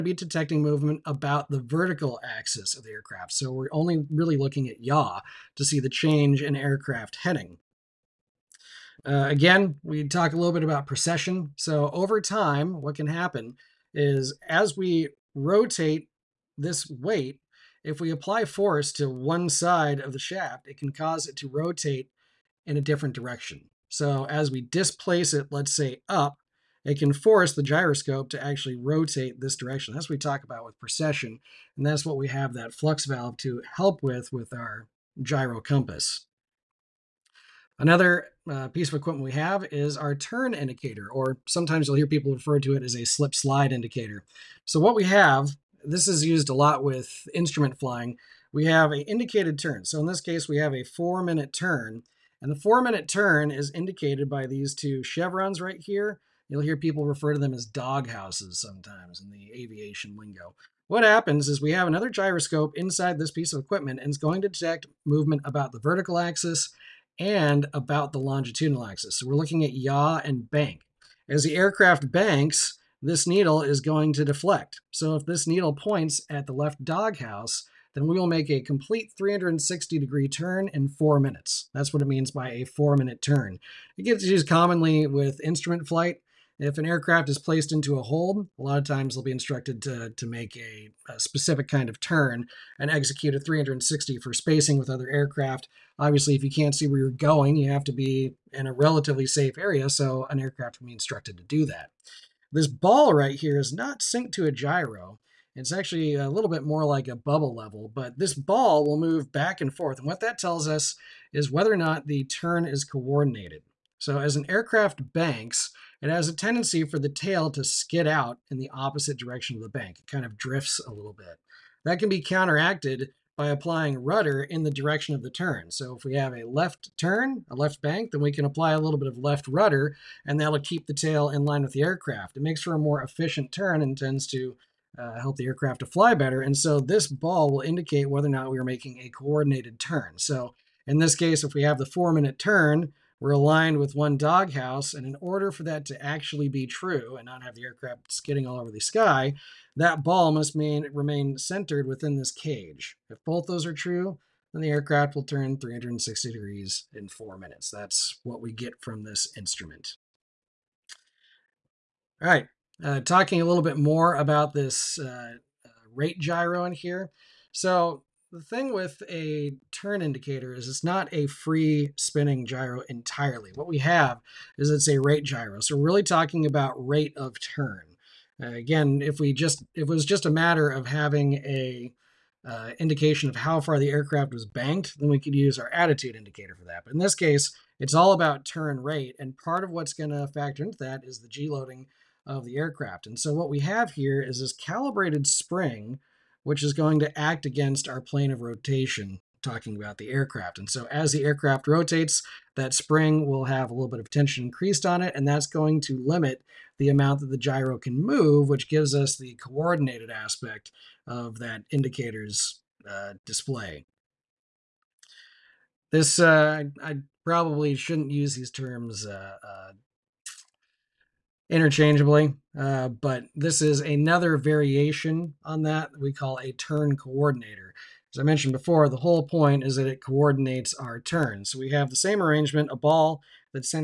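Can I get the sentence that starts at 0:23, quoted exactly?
So as we displace it, let's say up, it can force the gyroscope to actually rotate this direction.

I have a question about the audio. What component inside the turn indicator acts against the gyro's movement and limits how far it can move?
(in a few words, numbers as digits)
calibrated spring.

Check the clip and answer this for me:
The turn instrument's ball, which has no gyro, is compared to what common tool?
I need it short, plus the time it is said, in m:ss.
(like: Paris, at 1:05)
a bubble level, at 1:47.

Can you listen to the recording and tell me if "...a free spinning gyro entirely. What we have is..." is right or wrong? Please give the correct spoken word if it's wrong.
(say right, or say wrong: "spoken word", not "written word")
right.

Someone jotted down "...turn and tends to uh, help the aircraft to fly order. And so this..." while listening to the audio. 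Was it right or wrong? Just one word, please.
wrong.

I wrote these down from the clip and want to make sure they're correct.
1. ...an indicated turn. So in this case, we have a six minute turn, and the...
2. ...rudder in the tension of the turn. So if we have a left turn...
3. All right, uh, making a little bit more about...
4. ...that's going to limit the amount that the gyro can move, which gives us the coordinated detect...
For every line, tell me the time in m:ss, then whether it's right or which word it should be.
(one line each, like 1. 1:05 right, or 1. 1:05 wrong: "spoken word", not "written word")
1. 0:48 wrong: "four", not "six"
2. 2:04 wrong: "direction", not "tension"
3. 2:42 wrong: "talking", not "making"
4. 3:25 wrong: "aspect", not "detect".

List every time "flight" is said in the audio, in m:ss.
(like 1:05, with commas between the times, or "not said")
1:25.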